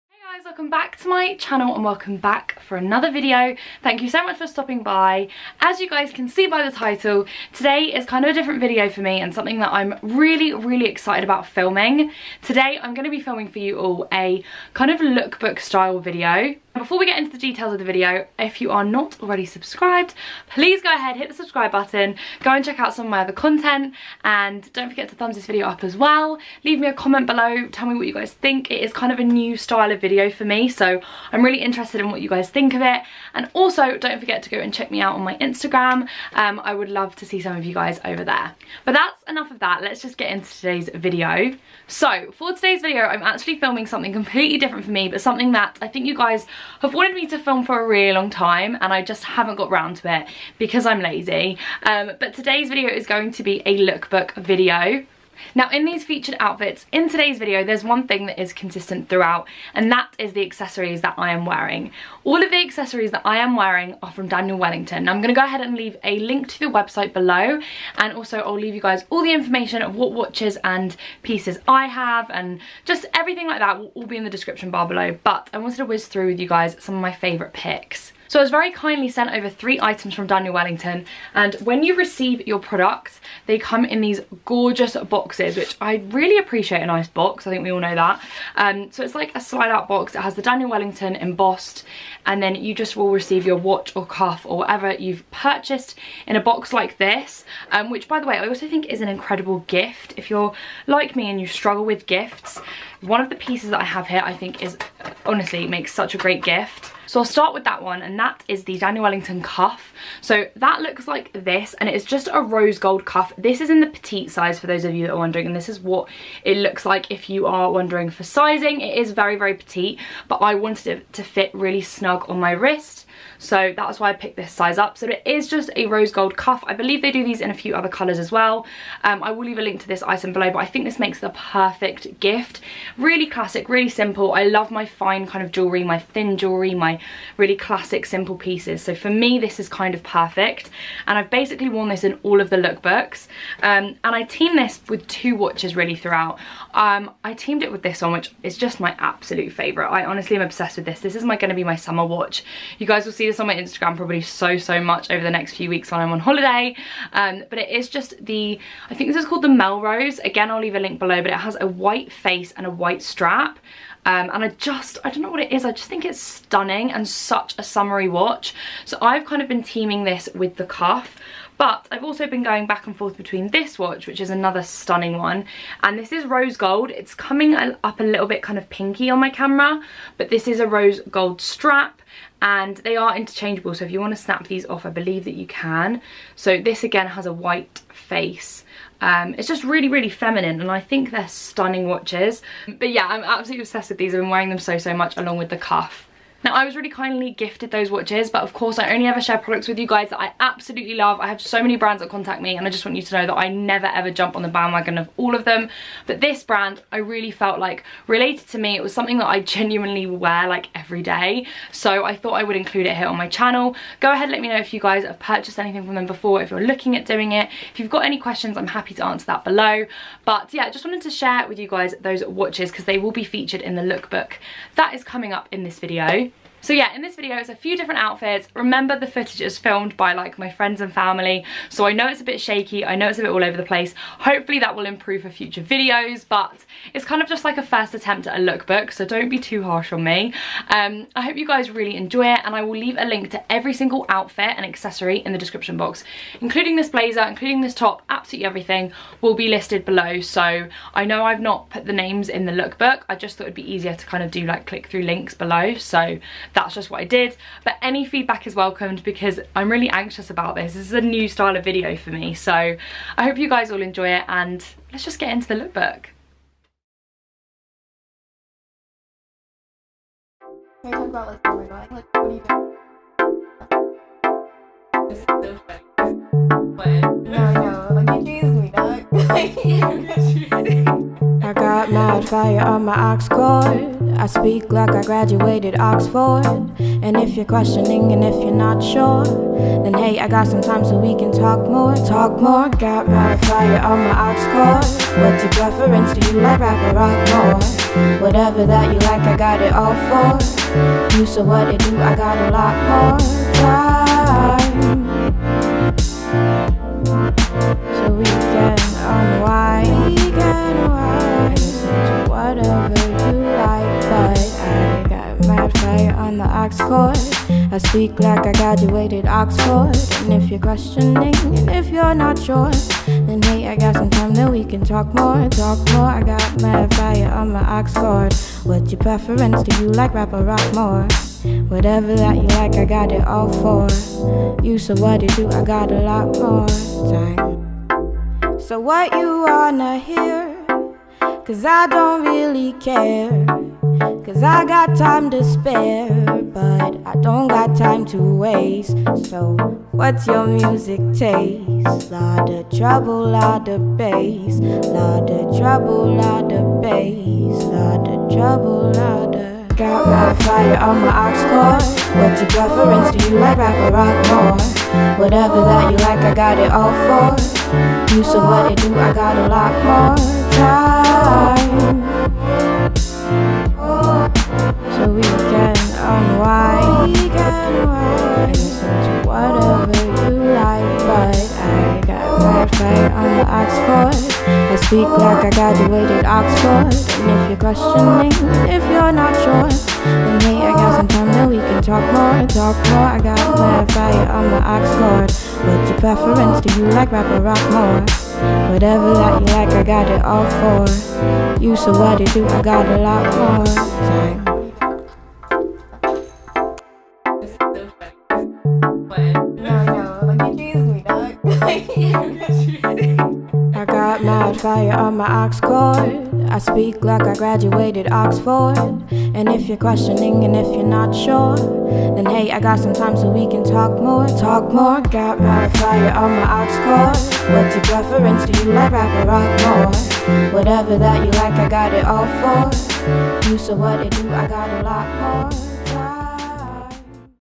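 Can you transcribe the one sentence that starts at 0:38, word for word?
But that's enough of that, let's just get into today's video.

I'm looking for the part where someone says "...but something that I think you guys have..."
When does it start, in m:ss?
0:45.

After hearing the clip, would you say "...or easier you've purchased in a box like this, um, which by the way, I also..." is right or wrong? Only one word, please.
wrong.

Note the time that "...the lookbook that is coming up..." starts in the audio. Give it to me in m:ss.
3:43.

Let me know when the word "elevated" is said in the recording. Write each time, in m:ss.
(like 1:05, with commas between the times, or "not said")
not said.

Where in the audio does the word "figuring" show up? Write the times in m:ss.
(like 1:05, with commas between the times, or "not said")
not said.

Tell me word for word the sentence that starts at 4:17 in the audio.
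But any feedback is welcomed because I'm really anxious about this.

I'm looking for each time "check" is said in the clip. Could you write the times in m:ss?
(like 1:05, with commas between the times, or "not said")
0:22, 0:34.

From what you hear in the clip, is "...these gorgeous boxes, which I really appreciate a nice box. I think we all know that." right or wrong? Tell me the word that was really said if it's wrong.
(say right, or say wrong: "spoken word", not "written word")
right.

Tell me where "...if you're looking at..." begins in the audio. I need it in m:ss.
3:36.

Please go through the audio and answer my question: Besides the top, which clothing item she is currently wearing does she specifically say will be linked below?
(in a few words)
Blazer.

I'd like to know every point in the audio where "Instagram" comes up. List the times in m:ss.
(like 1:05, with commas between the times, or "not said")
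0:35, 2:33.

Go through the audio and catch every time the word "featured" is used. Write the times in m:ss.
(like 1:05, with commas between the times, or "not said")
0:56, 3:43.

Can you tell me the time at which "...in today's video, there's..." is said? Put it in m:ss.
0:56.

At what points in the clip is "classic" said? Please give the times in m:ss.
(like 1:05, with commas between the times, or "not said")
2:13, 2:17.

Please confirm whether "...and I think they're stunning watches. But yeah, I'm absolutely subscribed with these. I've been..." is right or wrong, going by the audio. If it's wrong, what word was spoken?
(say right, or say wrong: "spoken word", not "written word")
wrong: "obsessed", not "subscribed".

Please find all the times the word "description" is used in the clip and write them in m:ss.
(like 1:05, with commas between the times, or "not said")
1:14, 4:05.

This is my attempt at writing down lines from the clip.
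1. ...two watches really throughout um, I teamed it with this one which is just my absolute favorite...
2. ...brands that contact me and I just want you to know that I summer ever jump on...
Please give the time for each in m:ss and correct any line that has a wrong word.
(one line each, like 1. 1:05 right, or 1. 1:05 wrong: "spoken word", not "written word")
1. 2:25 right
2. 3:21 wrong: "never", not "summer".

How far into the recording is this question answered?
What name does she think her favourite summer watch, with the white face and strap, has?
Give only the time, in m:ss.
2:39.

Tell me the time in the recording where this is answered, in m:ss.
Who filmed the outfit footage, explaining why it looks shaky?
3:50.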